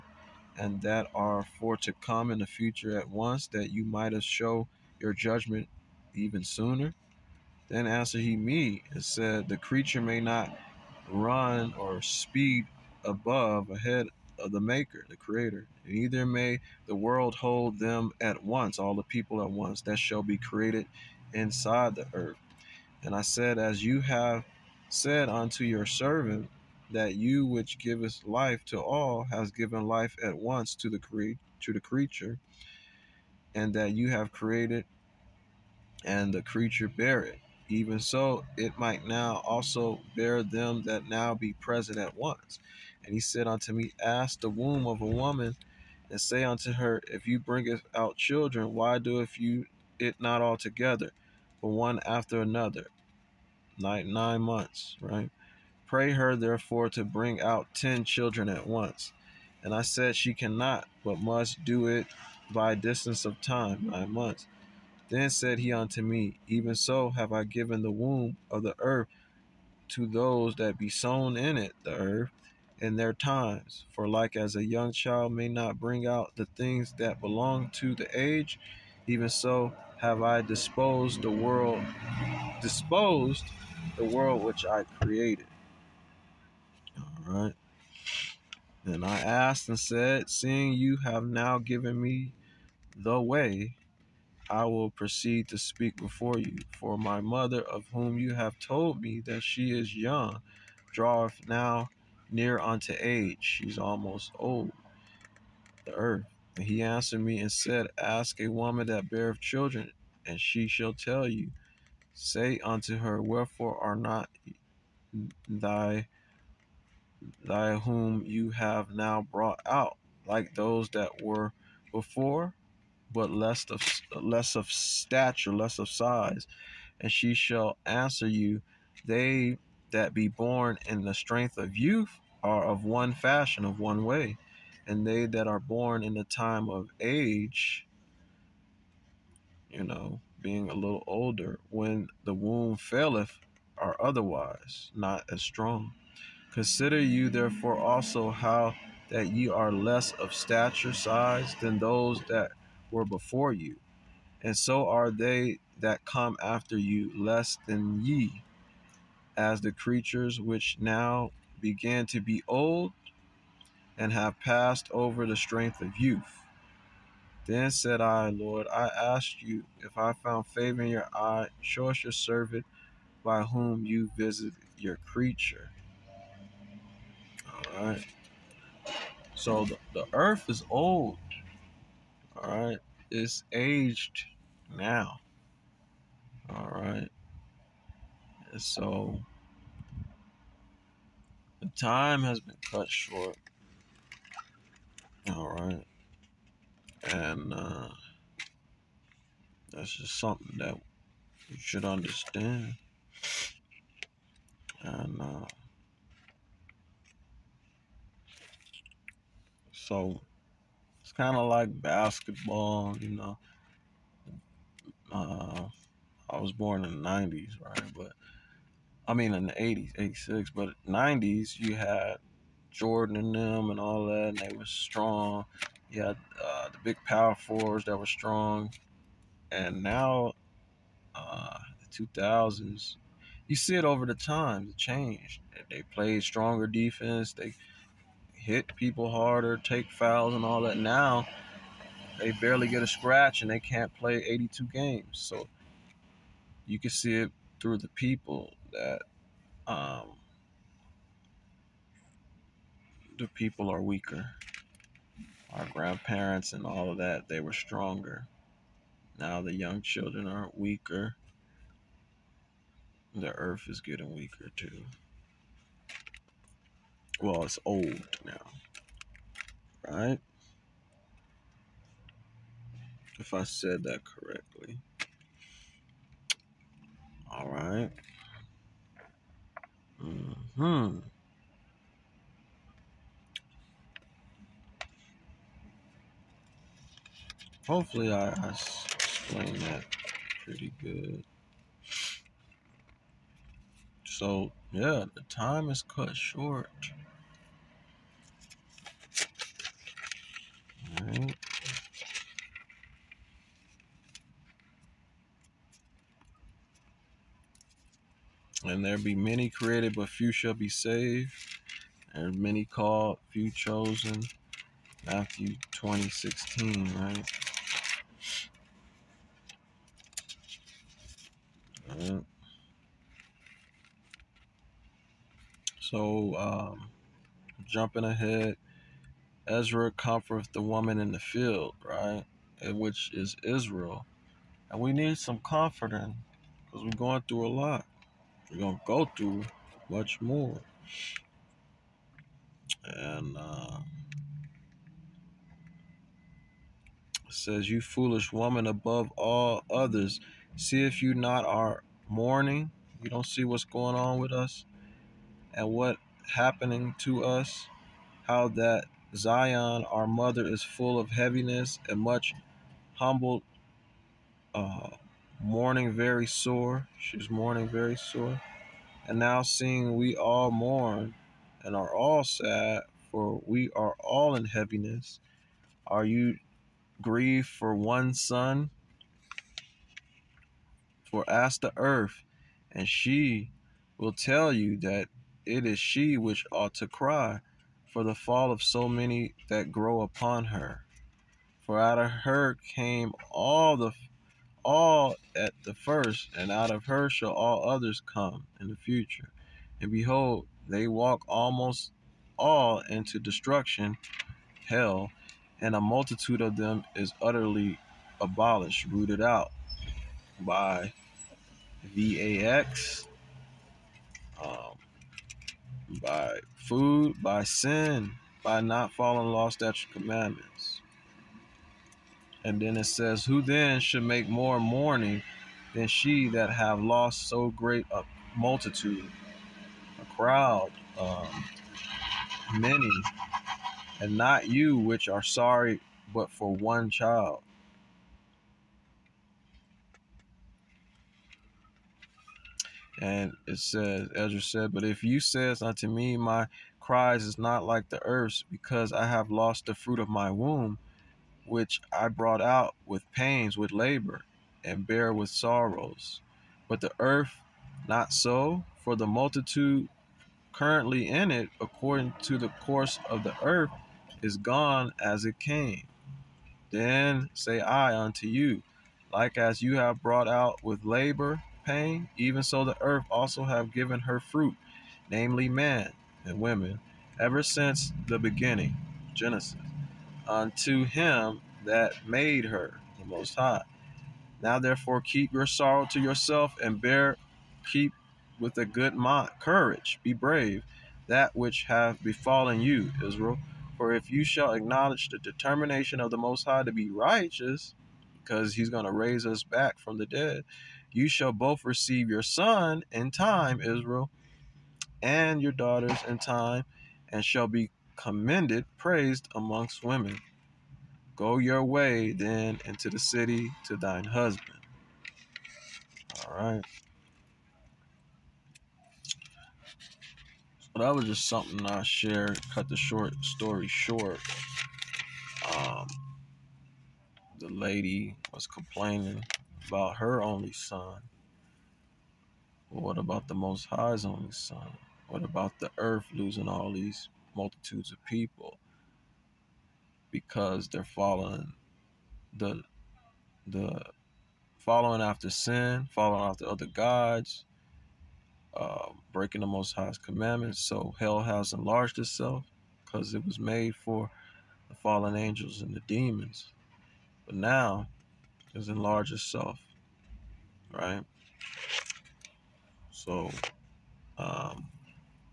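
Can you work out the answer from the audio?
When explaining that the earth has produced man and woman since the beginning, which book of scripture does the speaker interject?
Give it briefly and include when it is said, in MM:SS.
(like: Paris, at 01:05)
Genesis, at 07:59.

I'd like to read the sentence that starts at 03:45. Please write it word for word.
You had uh, the big power fours that were strong.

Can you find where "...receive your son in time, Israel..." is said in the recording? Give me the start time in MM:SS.
08:21.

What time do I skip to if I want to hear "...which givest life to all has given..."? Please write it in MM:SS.
00:27.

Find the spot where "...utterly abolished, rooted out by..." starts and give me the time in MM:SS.
06:47.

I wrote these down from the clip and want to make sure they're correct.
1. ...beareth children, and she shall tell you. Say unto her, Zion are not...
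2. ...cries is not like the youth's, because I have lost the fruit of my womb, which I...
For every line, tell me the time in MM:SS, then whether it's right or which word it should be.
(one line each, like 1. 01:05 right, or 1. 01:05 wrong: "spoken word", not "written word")
1. 01:49 wrong: "Wherefore", not "Zion"
2. 07:26 wrong: "earth", not "youth".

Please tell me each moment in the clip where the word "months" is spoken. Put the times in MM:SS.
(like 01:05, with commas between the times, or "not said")
00:54, 01:04.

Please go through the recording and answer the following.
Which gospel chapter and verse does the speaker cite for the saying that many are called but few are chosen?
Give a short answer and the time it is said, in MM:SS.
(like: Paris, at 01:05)
Matthew 20:16, at 05:15.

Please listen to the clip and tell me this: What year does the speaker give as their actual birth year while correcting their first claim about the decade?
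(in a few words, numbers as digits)
1986.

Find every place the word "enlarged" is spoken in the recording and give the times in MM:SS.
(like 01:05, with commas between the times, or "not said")
09:11, 09:18.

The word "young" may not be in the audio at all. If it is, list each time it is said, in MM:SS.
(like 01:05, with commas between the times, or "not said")
01:14, 01:39, 04:19.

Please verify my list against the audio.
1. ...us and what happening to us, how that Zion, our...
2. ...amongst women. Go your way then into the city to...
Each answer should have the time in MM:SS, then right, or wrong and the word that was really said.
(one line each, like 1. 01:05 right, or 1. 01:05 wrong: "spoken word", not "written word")
1. 05:54 right
2. 08:29 right.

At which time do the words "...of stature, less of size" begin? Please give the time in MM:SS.
02:04.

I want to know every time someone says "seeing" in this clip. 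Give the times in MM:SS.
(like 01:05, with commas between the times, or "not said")
01:30, 06:09.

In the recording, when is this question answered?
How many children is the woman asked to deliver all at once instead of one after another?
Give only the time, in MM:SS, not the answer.
00:57.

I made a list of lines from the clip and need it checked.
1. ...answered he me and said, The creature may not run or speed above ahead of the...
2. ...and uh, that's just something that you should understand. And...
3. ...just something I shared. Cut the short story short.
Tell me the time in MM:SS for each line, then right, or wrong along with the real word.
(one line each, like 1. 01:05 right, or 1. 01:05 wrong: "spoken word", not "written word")
1. 00:07 right
2. 03:17 right
3. 08:41 right.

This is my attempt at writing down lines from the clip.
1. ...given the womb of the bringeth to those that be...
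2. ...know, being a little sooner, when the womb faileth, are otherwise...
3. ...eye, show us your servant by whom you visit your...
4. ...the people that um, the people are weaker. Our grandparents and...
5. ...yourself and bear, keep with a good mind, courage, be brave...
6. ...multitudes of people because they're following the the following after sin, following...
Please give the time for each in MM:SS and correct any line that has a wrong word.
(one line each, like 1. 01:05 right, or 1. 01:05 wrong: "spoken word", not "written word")
1. 01:07 wrong: "earth", not "bringeth"
2. 02:19 wrong: "older", not "sooner"
3. 02:51 right
4. 04:07 right
5. 08:06 right
6. 08:57 right.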